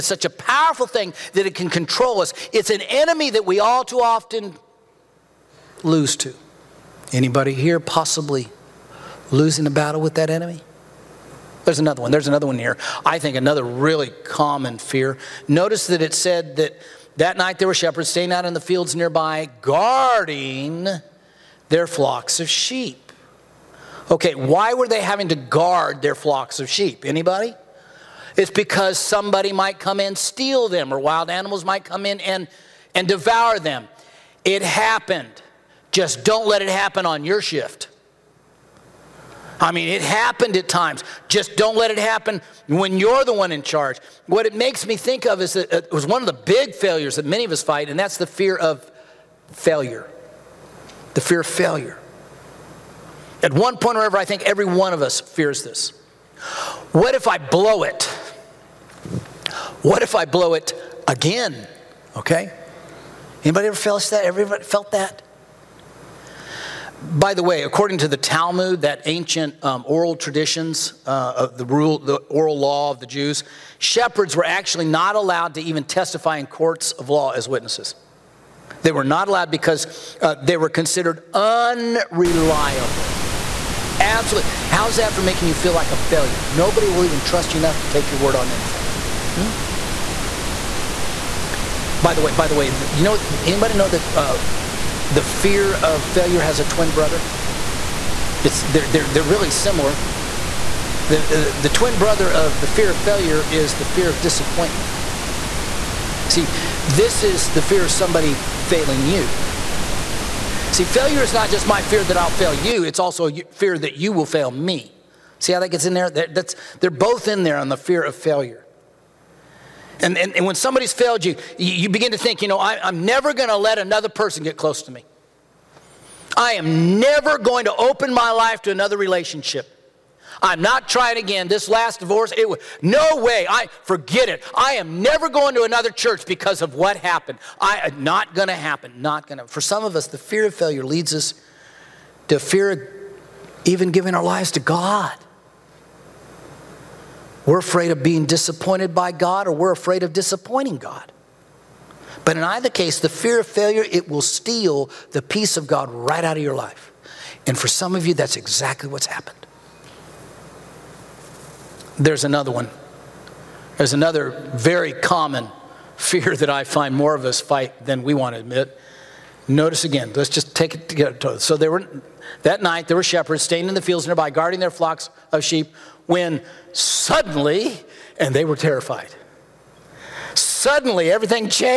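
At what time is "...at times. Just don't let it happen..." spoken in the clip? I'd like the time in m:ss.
0:40.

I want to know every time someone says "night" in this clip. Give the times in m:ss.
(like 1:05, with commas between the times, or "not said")
0:17, 2:52.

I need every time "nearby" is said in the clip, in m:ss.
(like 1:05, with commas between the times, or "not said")
0:18, 2:54.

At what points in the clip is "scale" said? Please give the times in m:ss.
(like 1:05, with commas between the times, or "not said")
not said.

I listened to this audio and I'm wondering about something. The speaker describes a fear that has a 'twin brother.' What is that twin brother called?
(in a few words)
Fear of disappointment.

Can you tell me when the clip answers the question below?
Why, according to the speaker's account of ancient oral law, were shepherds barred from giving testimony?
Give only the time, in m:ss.
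1:20.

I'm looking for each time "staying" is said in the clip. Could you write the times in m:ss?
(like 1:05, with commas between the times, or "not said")
0:18, 2:53.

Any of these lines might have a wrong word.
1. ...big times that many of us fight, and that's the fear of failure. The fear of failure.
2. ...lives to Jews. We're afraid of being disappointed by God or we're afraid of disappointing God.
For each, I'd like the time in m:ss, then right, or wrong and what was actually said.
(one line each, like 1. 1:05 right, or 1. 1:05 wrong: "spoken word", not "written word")
1. 0:46 wrong: "failures", not "times"
2. 2:24 wrong: "God", not "Jews".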